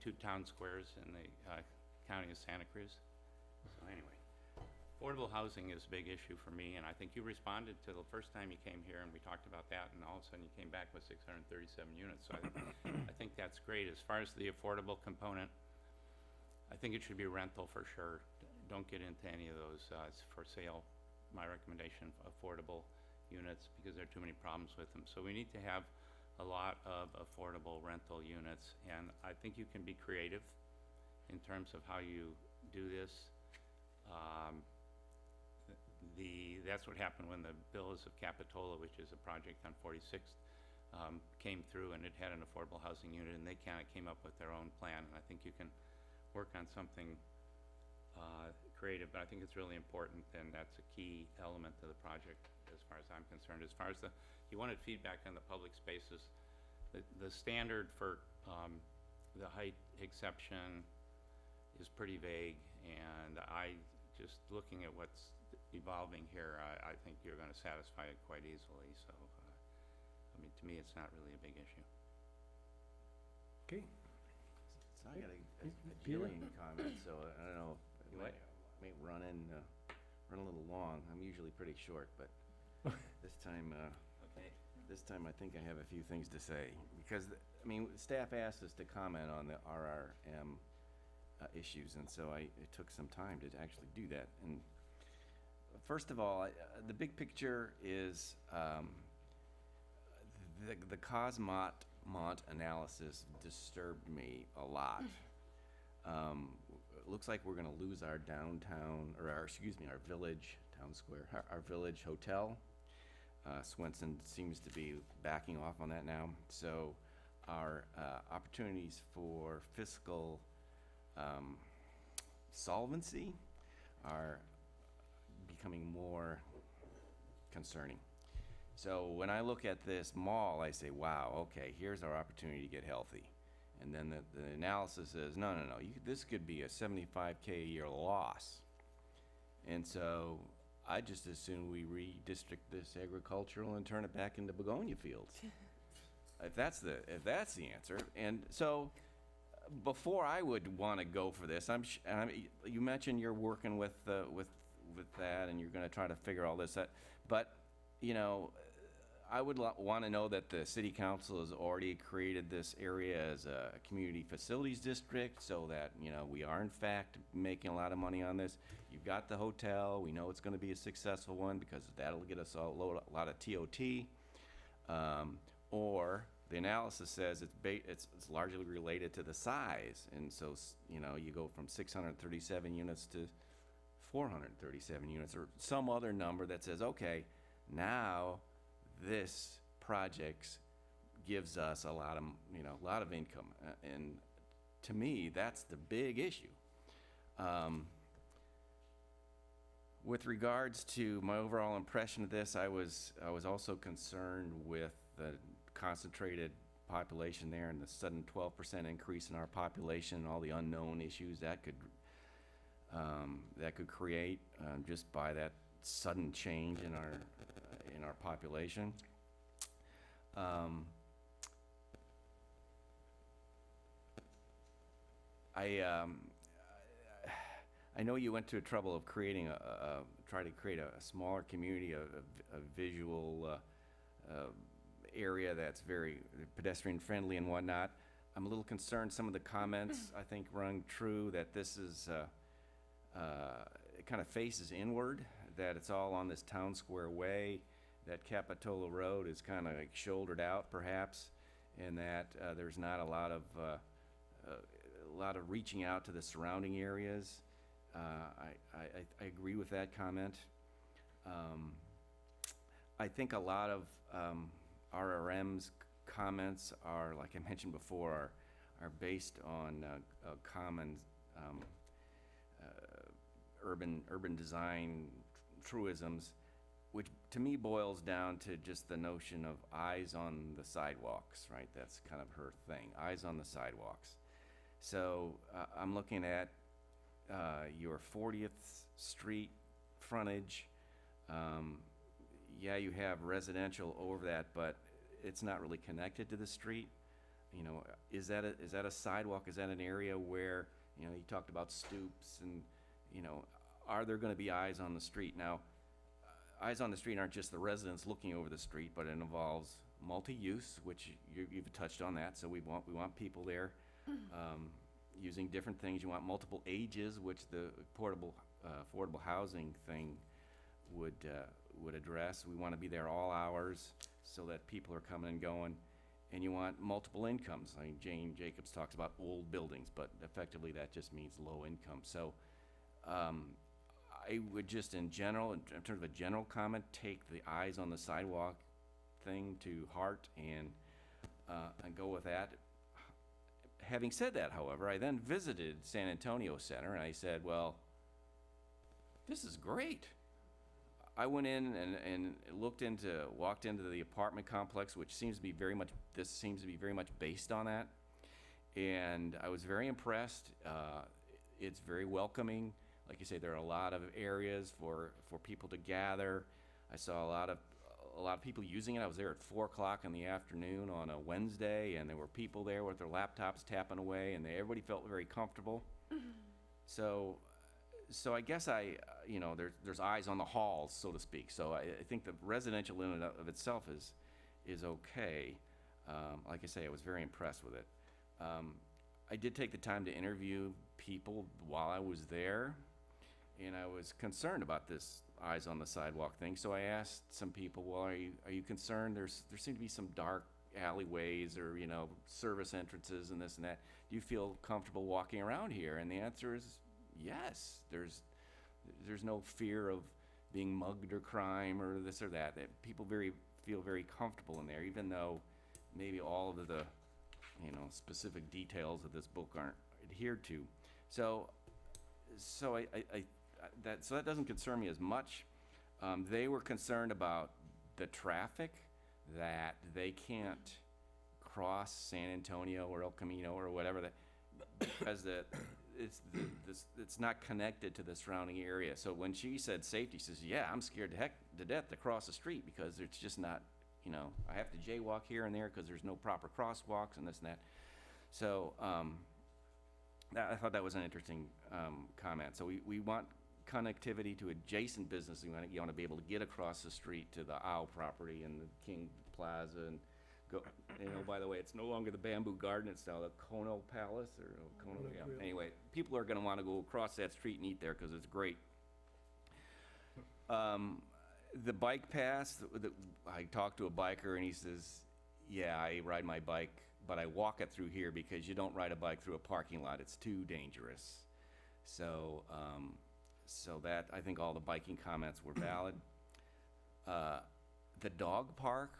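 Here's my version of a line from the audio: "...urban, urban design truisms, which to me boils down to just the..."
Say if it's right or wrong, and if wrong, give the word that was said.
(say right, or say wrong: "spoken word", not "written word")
right.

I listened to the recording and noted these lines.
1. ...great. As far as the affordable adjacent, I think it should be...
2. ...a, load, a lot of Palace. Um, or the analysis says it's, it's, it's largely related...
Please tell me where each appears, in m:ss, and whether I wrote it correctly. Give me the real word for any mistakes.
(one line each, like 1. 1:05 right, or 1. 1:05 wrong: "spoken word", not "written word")
1. 0:13 wrong: "component", not "adjacent"
2. 2:52 wrong: "TOT", not "Palace".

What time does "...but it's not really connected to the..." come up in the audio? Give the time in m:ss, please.
4:54.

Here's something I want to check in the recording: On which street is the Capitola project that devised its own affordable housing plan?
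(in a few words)
46th.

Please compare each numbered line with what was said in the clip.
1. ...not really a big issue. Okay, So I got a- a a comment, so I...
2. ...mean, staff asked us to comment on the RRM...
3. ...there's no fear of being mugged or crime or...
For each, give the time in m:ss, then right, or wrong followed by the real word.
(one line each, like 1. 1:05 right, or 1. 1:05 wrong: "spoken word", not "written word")
1. 1:10 right
2. 1:27 right
3. 6:49 right.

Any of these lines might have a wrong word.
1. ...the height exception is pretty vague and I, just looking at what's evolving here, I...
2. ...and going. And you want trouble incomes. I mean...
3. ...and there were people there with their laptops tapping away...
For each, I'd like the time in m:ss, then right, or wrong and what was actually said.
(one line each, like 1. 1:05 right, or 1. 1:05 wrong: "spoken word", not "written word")
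1. 0:59 right
2. 5:25 wrong: "multiple", not "trouble"
3. 6:11 right.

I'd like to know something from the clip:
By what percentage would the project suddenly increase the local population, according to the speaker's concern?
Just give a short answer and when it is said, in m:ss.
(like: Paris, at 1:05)
12 percent, at 3:28.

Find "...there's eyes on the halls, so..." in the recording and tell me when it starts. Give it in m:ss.
6:19.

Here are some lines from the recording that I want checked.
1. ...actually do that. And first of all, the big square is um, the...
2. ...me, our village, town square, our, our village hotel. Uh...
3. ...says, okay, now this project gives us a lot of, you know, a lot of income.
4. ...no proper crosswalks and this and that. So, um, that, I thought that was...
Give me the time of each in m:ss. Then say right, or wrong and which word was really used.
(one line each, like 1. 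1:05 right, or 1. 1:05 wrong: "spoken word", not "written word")
1. 1:33 wrong: "picture", not "square"
2. 1:49 right
3. 3:06 right
4. 7:26 right.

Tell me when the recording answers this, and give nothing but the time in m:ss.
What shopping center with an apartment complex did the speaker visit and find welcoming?
5:45.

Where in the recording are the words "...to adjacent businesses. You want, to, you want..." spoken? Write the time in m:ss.
7:34.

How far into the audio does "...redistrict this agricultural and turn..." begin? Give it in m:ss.
2:21.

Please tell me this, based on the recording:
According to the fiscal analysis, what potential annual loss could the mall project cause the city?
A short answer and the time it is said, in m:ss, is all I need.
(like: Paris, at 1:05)
75K, at 2:16.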